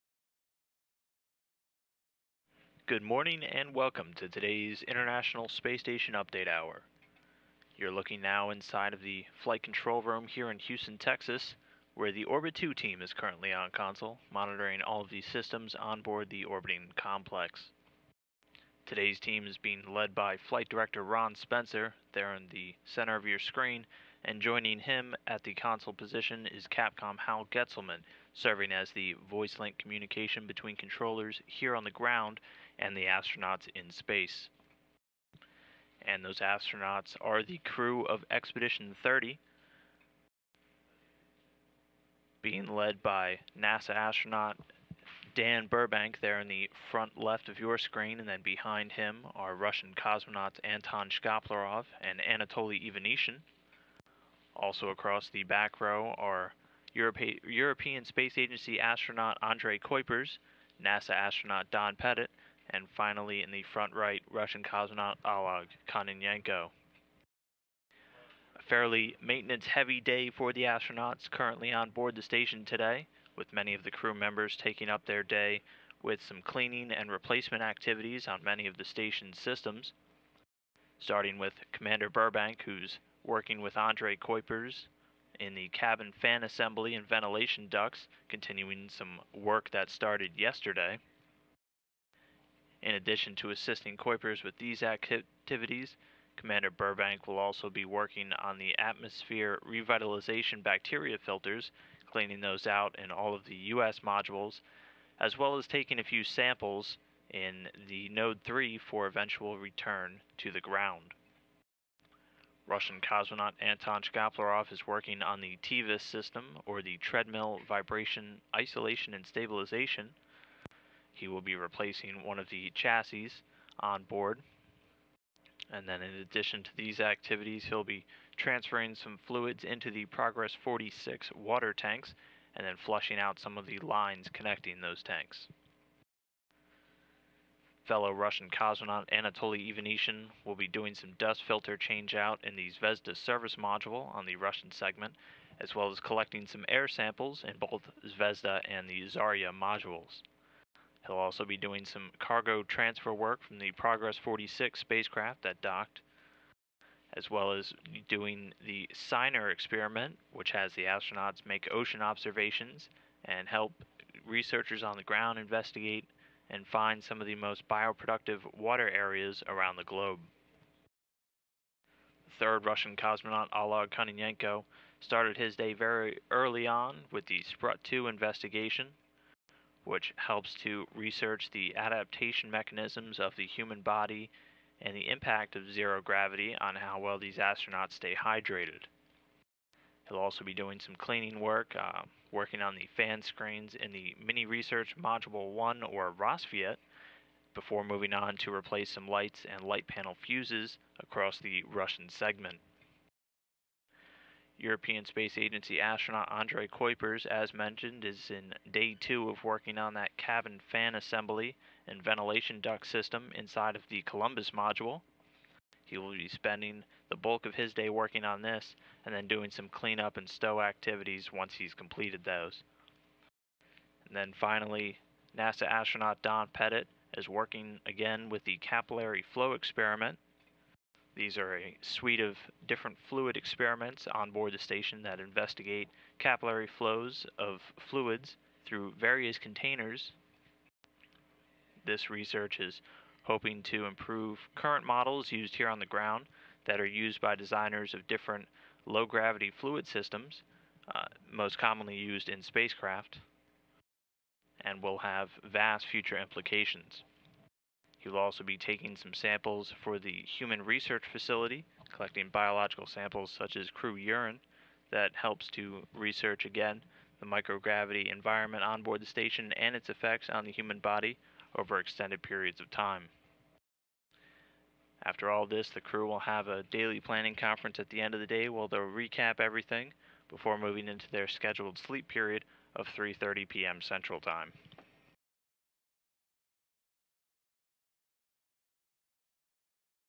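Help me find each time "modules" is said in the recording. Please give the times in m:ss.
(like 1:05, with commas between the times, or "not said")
1:43, 2:23, 2:29, 3:14, 3:34.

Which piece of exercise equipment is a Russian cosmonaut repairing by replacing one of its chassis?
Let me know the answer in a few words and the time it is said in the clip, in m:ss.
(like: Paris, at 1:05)
TVIS, at 1:55.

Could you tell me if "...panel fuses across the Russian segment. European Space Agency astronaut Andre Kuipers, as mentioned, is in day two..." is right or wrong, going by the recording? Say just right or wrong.
right.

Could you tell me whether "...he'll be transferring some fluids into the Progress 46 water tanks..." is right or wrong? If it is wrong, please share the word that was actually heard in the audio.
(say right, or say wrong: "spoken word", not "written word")
right.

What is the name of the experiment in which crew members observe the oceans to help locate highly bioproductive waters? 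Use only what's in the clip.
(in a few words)
Seiner.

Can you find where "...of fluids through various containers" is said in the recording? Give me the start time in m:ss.
3:57.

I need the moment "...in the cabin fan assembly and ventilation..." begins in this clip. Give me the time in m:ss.
1:25.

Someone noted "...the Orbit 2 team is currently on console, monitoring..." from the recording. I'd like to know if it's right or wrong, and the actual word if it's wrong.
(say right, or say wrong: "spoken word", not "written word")
right.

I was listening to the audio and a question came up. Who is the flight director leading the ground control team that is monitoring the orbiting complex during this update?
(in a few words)
Ron Spencer.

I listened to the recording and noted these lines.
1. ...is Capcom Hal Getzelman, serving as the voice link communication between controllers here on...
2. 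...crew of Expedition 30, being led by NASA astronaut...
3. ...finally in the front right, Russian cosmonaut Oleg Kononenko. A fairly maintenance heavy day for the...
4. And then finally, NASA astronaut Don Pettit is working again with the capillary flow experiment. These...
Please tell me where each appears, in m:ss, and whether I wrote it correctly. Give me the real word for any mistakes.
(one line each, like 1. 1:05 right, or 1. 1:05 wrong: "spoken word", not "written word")
1. 0:26 right
2. 0:37 right
3. 1:02 right
4. 3:44 right.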